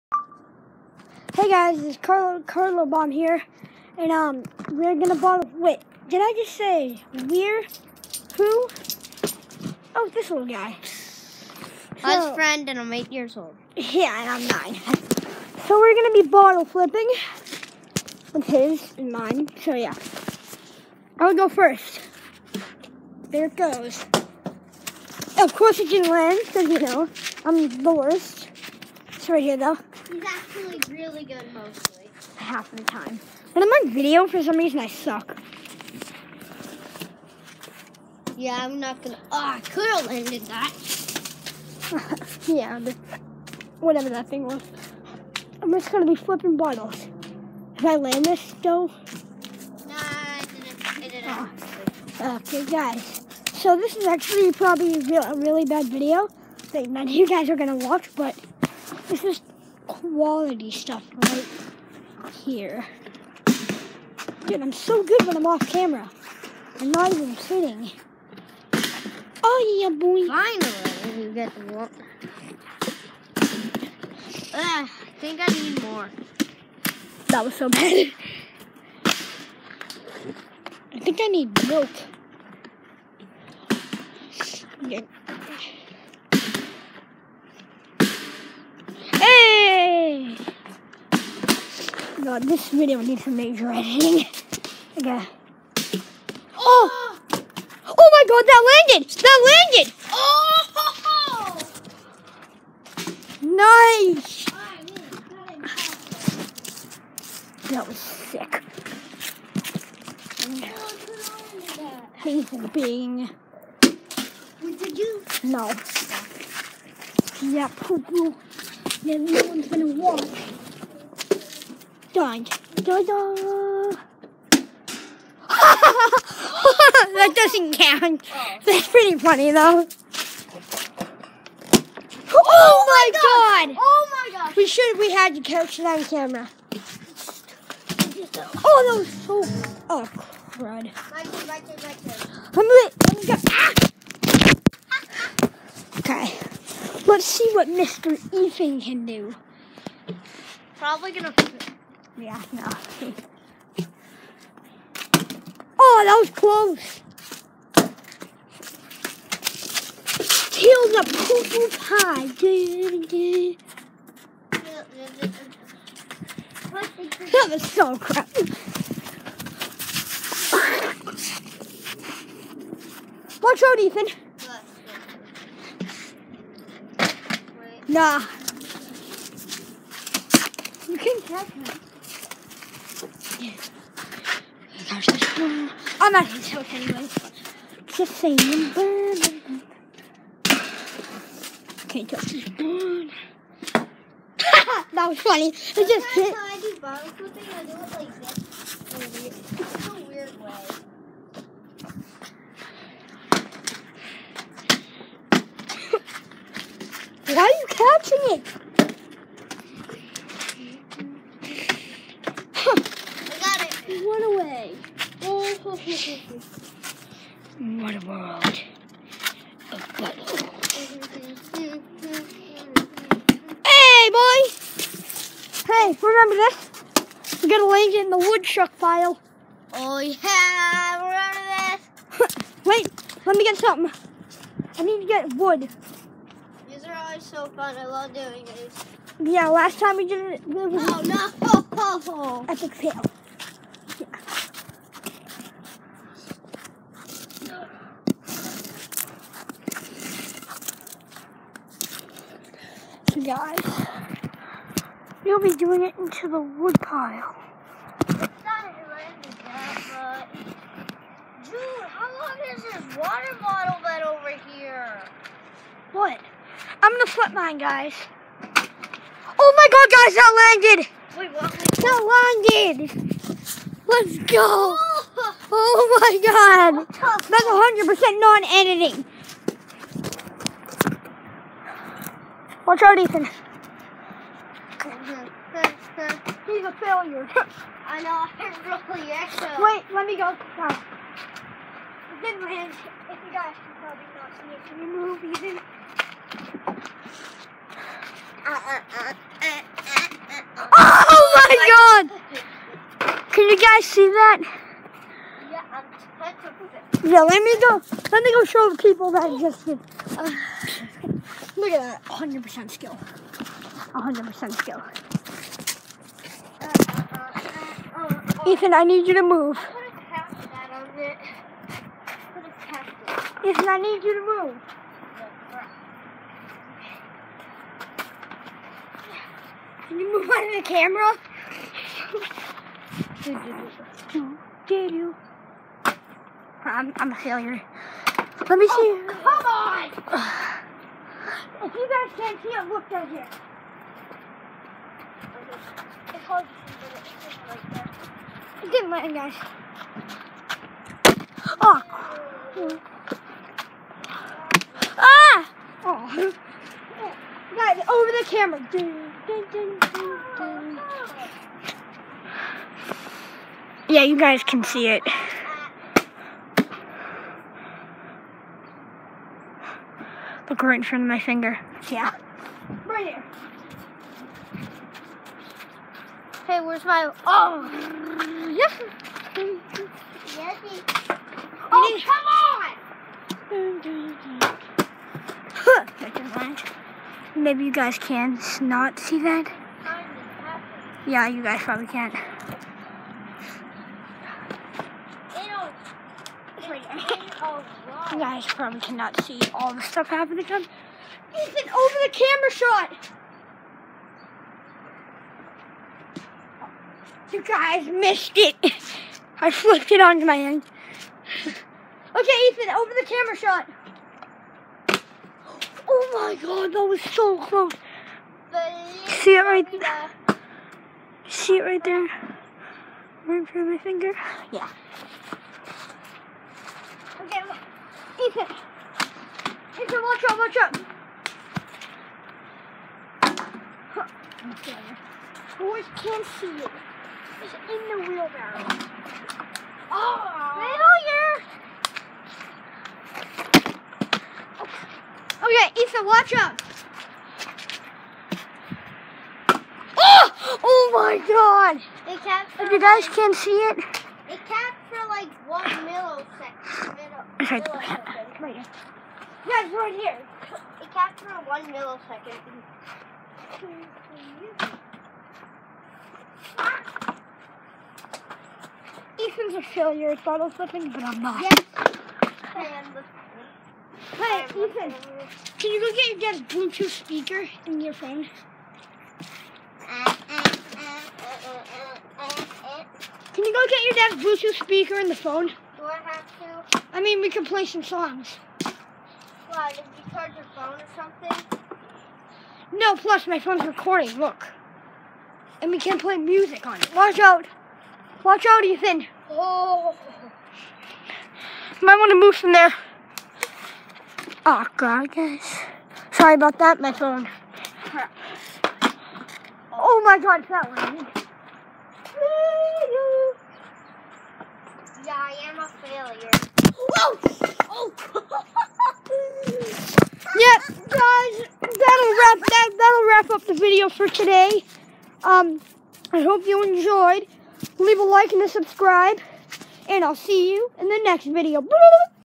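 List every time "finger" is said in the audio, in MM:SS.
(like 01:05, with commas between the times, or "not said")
06:11, 07:03.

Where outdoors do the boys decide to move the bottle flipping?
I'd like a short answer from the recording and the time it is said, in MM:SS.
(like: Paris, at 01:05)
the woodchuck pile, at 03:48.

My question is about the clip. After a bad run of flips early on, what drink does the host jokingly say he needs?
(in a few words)
milk.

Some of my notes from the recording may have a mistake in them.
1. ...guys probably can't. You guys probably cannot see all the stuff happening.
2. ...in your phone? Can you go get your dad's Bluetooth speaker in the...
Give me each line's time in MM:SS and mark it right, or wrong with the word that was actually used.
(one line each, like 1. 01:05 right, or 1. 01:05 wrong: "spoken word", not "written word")
1. 06:31 right
2. 07:57 right.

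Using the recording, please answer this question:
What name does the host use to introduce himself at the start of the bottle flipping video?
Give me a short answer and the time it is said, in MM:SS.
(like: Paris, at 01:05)
Carlo Carlo Bomb, at 00:01.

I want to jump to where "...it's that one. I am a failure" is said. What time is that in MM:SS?
08:30.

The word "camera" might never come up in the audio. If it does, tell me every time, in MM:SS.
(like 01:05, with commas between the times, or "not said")
01:05, 02:16, 05:30, 05:58, 06:42, 06:53.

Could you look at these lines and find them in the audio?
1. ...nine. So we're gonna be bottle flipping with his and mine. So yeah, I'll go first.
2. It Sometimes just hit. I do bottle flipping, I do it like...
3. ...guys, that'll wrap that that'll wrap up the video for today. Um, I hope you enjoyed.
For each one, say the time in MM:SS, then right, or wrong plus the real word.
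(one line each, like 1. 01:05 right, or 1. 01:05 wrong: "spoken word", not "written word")
1. 00:14 right
2. 03:15 right
3. 08:40 right.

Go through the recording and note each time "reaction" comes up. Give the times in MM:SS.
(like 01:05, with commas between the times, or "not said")
not said.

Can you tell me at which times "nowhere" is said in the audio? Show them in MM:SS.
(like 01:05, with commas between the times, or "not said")
not said.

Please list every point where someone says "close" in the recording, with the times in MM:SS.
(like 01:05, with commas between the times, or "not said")
02:36, 06:57.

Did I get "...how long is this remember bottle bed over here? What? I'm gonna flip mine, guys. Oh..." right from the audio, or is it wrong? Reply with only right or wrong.
wrong.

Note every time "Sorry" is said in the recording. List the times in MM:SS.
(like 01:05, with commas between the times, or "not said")
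08:26.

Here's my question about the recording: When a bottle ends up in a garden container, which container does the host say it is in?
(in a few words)
the wheelbarrow.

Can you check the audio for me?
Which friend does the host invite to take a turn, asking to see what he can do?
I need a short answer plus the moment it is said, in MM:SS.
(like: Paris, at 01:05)
Mr. Ethan, at 02:27.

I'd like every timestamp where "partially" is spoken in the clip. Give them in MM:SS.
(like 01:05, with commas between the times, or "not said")
not said.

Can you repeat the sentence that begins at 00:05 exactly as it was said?
Wait, did I just say we're who?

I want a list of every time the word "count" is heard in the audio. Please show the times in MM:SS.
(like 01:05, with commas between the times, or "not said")
02:07.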